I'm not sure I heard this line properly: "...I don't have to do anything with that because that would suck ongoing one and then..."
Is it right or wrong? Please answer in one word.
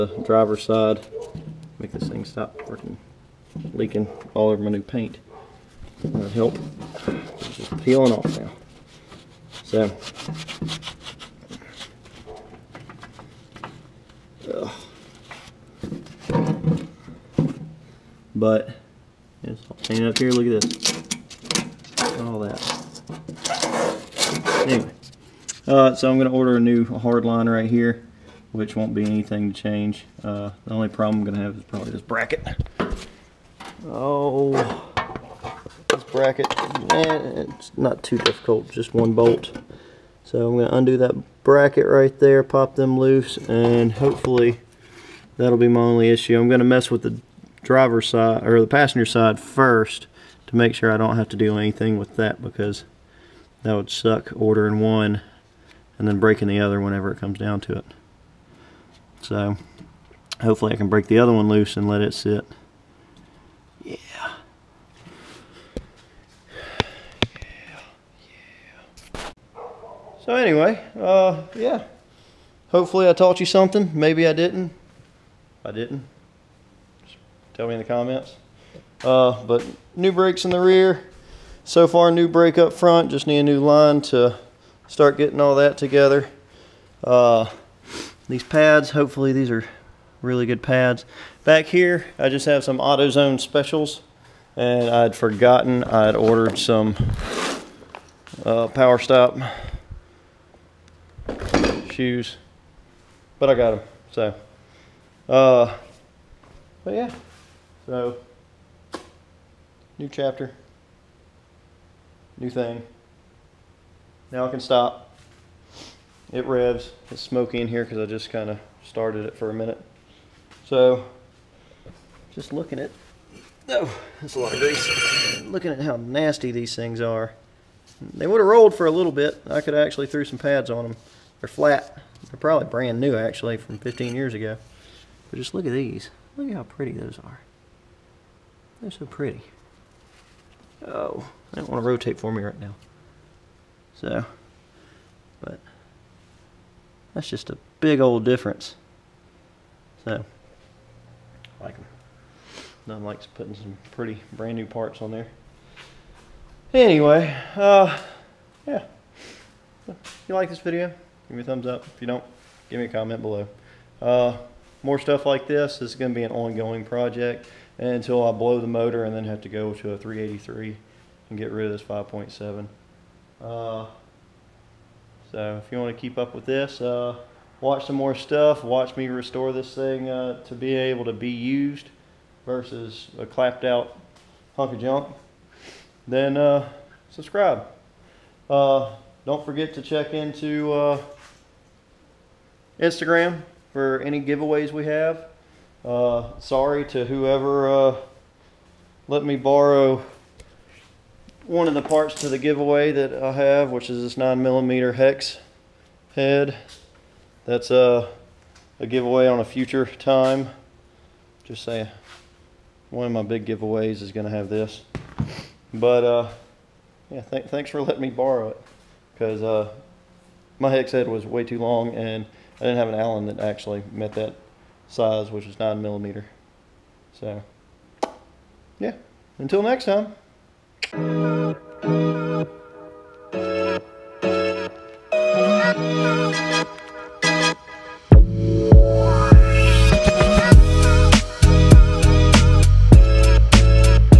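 wrong.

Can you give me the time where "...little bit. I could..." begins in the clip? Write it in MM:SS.
02:08.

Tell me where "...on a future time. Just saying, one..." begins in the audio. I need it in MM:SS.
03:29.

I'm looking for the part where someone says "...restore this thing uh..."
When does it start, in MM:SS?
02:59.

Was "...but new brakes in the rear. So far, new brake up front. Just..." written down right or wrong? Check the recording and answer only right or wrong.
right.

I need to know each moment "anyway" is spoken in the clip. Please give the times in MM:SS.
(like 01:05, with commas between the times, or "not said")
00:24, 01:10, 02:36.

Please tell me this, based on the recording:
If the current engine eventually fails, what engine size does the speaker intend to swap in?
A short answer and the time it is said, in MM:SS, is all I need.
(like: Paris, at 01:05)
383, at 02:49.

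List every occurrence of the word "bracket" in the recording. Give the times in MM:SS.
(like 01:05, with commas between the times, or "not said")
00:32, 00:36, 00:41.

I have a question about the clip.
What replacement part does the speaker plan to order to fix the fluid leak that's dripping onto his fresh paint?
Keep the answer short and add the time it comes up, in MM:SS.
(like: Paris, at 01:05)
new hard line, at 00:26.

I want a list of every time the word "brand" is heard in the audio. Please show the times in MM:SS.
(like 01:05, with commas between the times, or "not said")
02:12, 02:34.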